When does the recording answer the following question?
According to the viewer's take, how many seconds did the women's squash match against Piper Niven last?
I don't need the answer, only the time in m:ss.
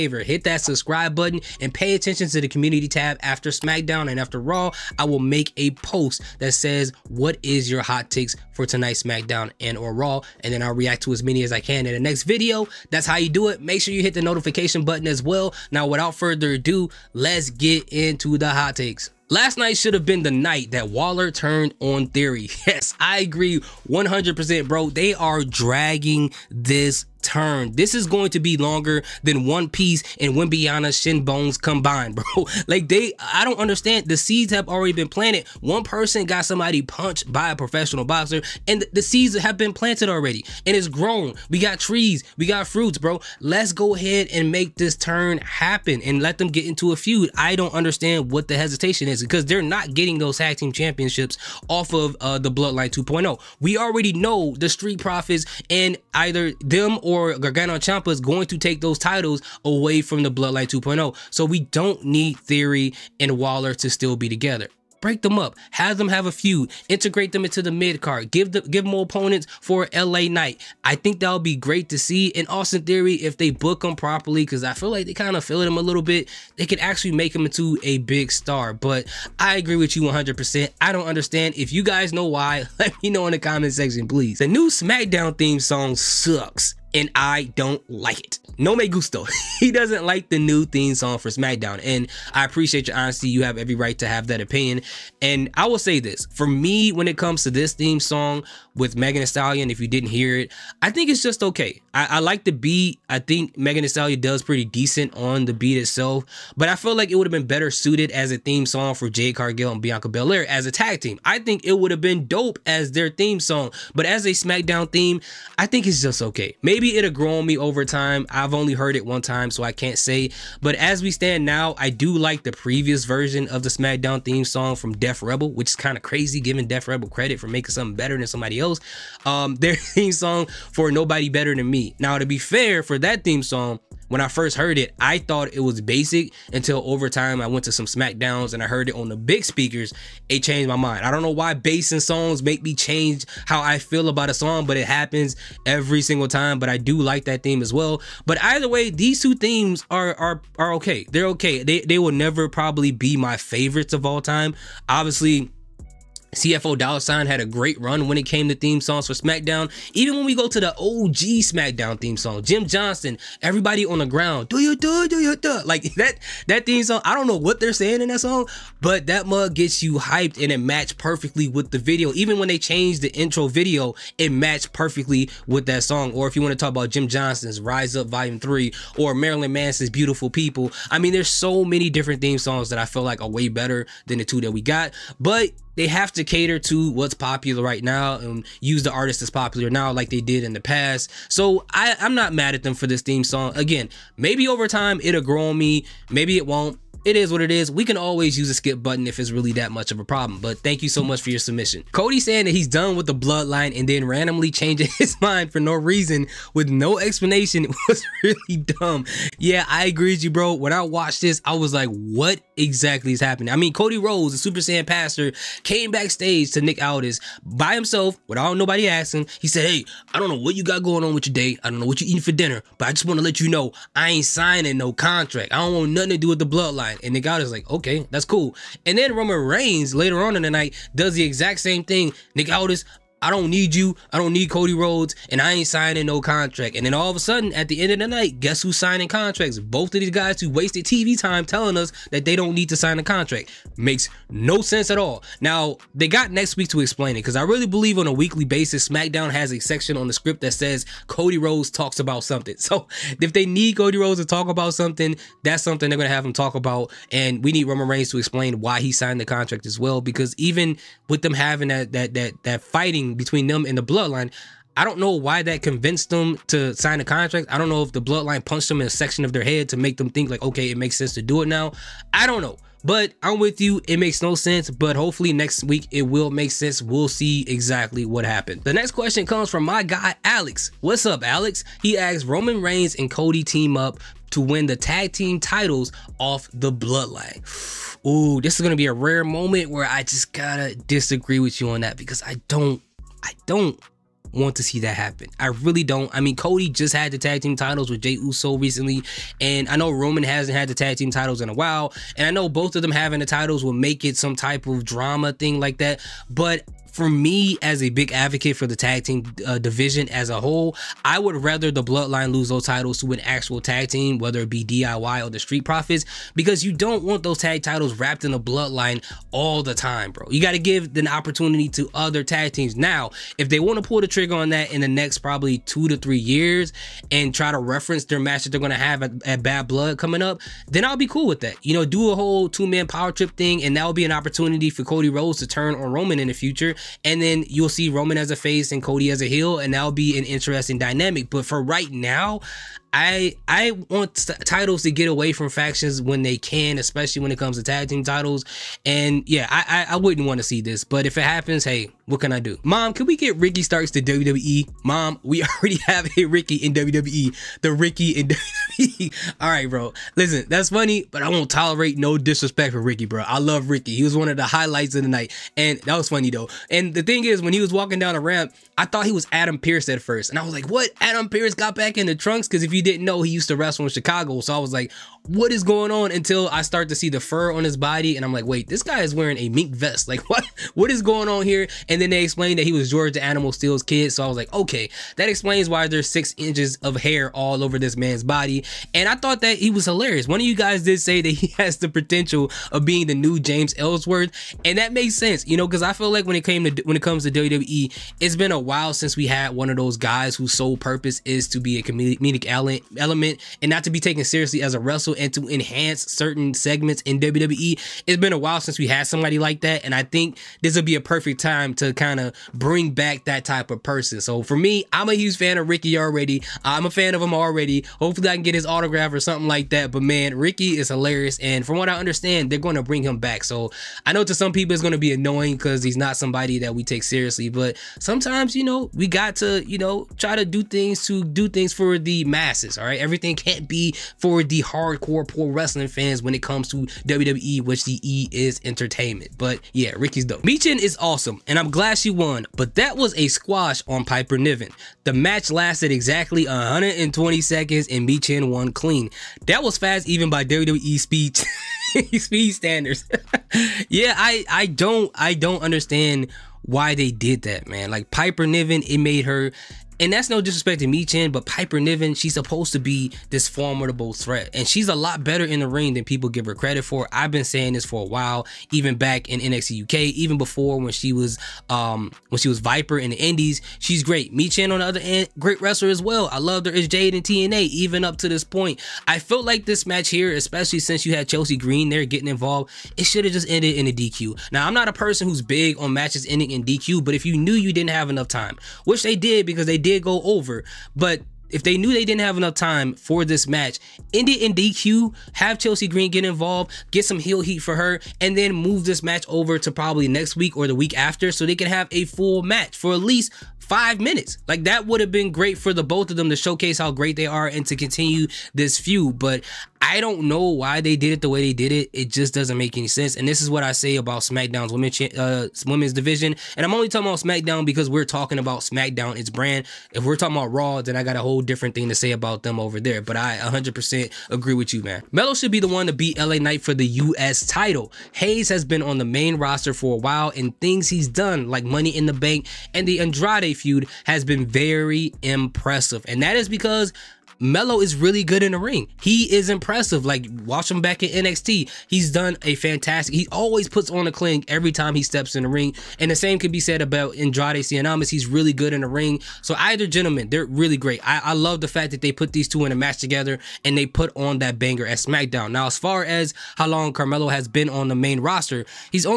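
7:26.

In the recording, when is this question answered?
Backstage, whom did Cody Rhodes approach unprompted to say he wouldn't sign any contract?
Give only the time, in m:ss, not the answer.
3:36.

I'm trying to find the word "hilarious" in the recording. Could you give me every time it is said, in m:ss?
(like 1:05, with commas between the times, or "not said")
6:29, 7:00.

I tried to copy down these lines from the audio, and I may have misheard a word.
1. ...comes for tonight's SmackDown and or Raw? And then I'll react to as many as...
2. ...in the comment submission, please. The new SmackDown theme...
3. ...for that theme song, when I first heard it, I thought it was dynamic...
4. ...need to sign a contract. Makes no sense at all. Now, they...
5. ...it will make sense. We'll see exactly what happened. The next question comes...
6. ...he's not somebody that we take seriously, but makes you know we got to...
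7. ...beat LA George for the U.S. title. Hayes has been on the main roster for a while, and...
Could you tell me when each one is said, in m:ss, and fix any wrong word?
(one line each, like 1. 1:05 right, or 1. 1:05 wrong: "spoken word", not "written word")
1. 0:08 wrong: "takes", not "comes"
2. 1:23 wrong: "section", not "submission"
3. 2:12 wrong: "basic", not "dynamic"
4. 4:02 right
5. 4:35 right
6. 7:05 wrong: "sometimes", not "makes"
7. 8:45 wrong: "Knight", not "George".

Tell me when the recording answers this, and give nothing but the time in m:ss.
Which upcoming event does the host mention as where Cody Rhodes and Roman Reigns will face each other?
5:29.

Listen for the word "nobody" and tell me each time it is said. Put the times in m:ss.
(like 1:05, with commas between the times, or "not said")
2:10, 3:38.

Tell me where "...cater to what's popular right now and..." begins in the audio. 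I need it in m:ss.
3:06.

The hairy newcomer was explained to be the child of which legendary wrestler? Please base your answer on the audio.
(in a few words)
George the Animal Steele.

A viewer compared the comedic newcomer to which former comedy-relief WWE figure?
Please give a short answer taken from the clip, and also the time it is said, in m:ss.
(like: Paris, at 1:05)
James Ellsworth, at 6:33.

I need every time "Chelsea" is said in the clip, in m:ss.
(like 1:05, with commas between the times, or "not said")
8:01, 8:15.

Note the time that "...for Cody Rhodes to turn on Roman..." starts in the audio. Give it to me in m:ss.
5:34.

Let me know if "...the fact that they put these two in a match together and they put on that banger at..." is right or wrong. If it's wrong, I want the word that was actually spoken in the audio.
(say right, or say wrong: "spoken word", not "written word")
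right.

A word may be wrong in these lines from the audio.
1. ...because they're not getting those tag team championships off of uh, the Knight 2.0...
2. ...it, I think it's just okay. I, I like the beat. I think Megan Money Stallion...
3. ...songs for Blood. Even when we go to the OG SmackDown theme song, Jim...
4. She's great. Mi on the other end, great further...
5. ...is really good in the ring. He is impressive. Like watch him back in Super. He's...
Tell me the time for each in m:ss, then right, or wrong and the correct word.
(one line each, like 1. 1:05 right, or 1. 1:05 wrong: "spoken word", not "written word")
1. 0:49 wrong: "Bloodline", not "Knight"
2. 1:40 wrong: "Thee", not "Money"
3. 2:38 wrong: "SmackDown", not "Blood"
4. 7:53 wrong: "wrestler", not "further"
5. 8:57 wrong: "NXT", not "Super".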